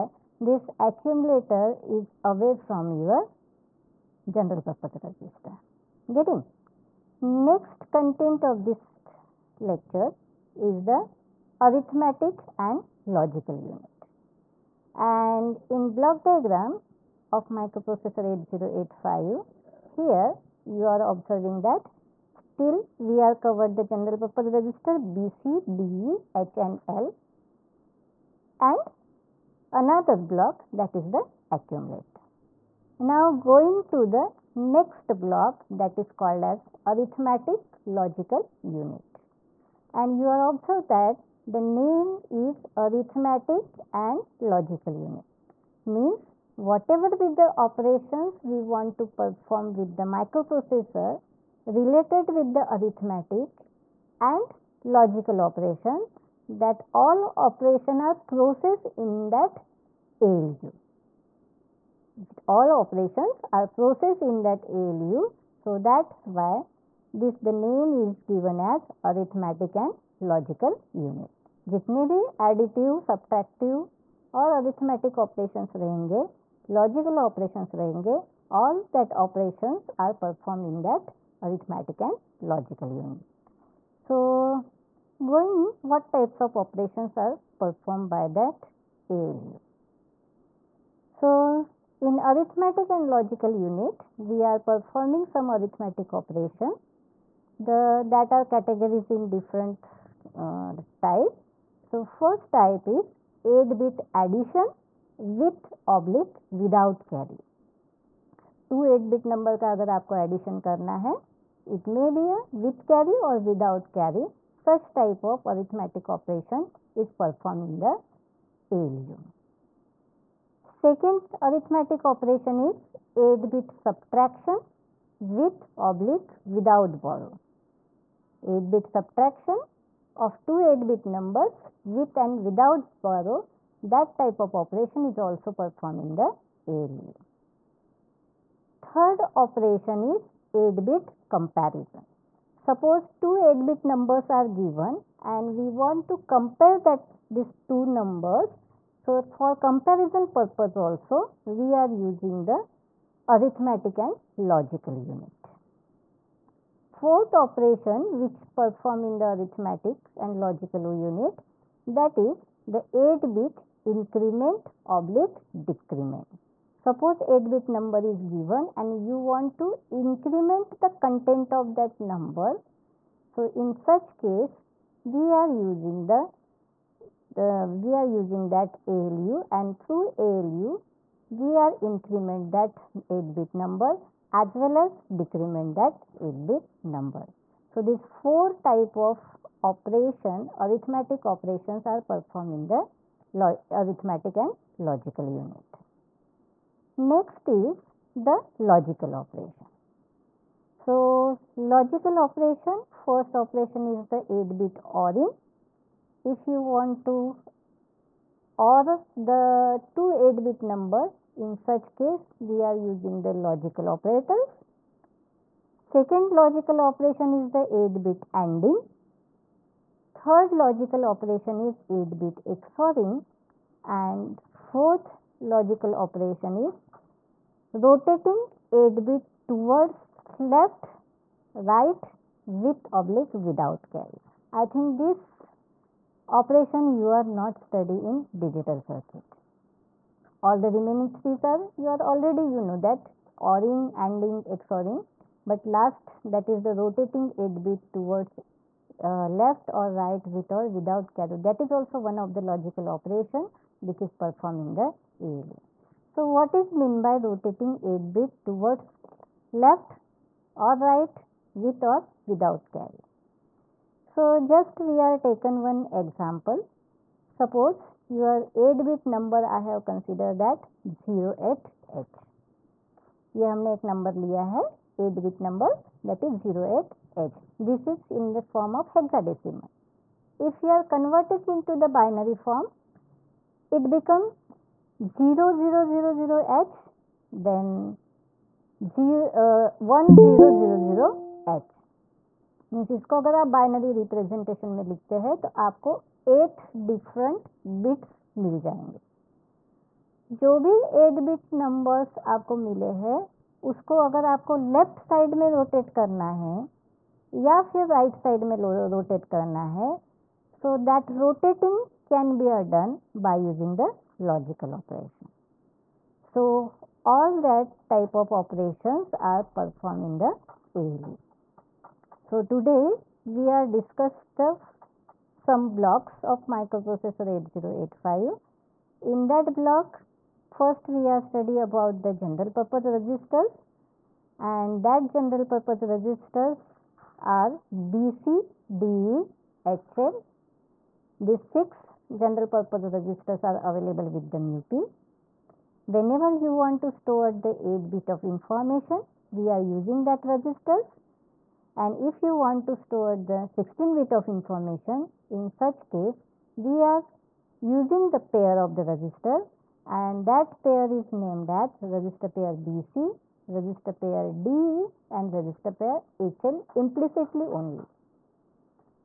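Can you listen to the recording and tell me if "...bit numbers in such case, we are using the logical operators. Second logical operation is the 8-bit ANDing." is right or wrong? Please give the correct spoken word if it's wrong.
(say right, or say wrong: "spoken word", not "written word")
right.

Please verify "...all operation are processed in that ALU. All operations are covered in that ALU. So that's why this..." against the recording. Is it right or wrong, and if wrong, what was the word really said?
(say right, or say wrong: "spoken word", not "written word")
wrong: "processed", not "covered".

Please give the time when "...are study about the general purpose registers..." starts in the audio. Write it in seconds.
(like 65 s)
331 s.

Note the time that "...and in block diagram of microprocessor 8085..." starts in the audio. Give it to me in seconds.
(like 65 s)
15 s.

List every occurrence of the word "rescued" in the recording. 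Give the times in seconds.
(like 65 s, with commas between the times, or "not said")
not said.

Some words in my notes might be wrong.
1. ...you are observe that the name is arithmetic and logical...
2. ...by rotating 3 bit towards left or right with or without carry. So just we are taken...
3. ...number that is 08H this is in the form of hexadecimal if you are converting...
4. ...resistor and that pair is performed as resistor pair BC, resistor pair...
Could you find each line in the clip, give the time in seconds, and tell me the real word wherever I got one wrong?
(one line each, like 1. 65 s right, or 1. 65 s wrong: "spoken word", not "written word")
1. 40 s right
2. 257 s wrong: "8", not "3"
3. 275 s right
4. 358 s wrong: "named", not "performed".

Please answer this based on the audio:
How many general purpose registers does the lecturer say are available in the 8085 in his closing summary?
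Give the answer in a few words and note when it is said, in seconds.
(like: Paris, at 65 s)
6, at 341 s.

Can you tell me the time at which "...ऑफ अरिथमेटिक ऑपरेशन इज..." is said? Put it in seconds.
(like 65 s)
115 s.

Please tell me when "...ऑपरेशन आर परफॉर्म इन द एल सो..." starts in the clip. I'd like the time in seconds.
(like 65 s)
318 s.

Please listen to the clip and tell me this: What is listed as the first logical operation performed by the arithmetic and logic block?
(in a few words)
8-bit ORing.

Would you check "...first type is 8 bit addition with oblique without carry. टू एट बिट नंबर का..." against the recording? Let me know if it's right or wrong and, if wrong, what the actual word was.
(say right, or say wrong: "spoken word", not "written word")
right.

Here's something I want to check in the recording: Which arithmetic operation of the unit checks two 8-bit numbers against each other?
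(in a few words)
8-bit comparison.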